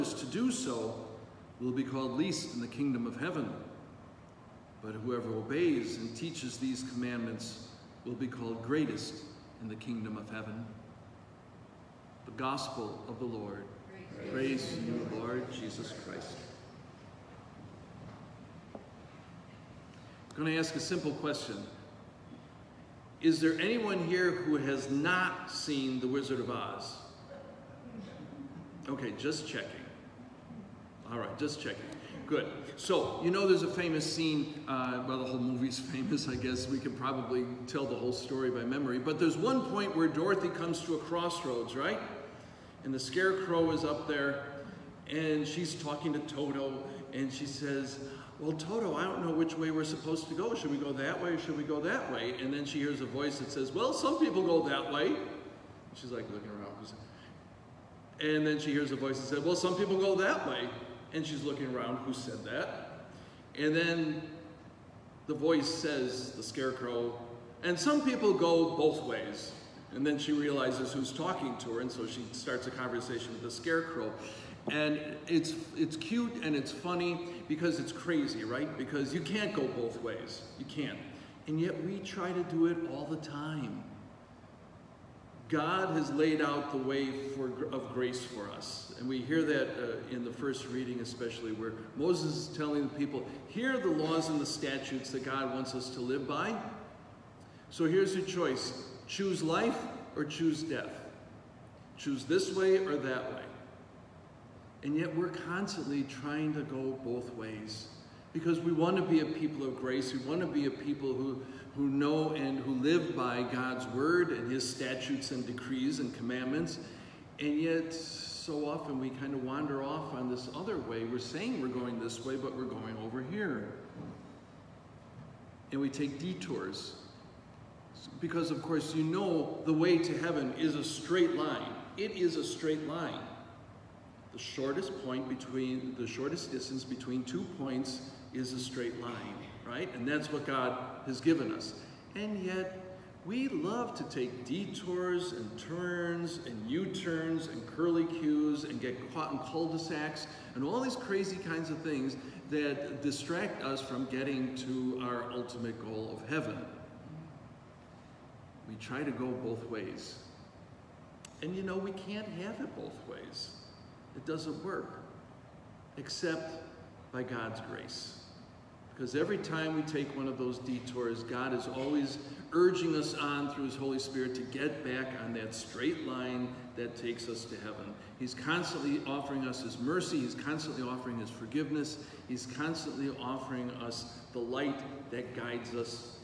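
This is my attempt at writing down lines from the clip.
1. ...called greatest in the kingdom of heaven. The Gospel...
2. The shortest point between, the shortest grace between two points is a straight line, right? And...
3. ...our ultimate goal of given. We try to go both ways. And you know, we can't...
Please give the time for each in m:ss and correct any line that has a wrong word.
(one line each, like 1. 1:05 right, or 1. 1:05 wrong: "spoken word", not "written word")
1. 0:08 right
2. 2:14 wrong: "distance", not "grace"
3. 2:35 wrong: "heaven", not "given".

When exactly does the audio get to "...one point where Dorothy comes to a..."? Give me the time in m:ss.
0:39.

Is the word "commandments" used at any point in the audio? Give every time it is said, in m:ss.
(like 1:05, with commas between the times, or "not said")
0:06, 1:56.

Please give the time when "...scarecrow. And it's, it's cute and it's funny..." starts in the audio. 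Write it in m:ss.
1:13.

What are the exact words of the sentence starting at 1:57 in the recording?
And yet, so often we kind of wander off on this other way.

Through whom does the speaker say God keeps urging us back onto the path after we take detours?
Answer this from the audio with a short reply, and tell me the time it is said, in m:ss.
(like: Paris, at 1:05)
His Holy Spirit, at 2:53.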